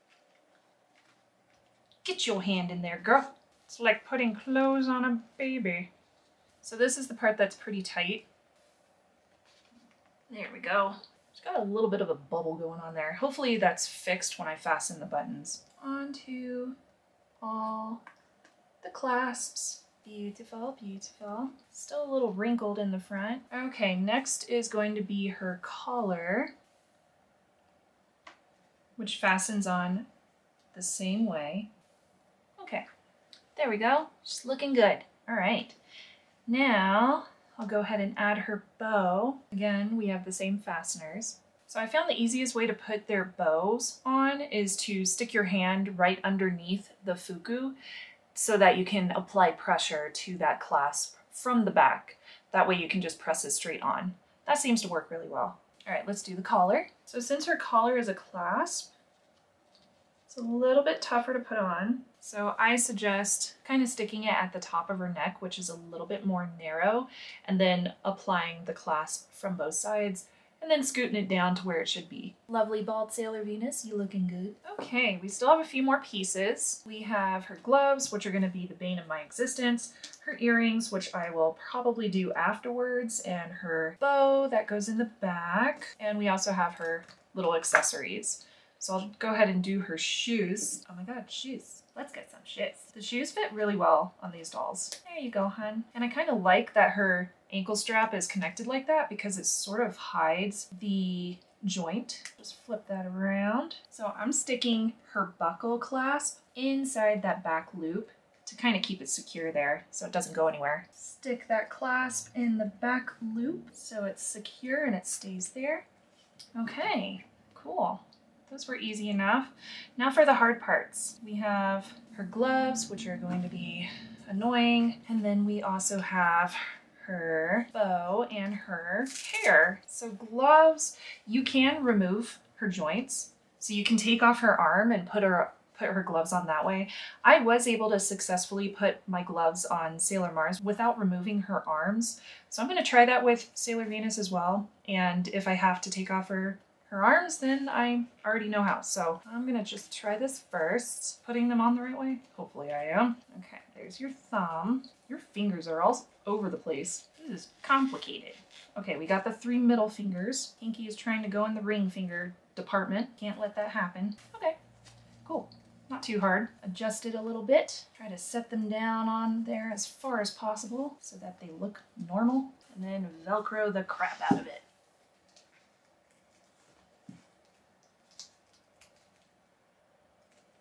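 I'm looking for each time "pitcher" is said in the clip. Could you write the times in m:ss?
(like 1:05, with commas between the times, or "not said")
not said.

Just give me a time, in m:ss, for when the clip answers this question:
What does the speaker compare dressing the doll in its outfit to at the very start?
0:04.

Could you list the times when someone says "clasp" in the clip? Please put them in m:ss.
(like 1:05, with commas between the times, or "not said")
0:18, 0:50, 0:58, 1:08, 1:45, 1:51.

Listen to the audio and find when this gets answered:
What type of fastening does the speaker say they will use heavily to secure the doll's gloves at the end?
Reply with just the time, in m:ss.
2:53.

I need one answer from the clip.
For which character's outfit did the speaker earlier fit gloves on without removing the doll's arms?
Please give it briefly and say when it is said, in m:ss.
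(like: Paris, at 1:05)
Sailor Mars, at 2:19.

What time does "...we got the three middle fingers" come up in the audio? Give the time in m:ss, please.
2:38.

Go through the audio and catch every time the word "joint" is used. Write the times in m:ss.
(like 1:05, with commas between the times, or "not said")
1:41, 2:12.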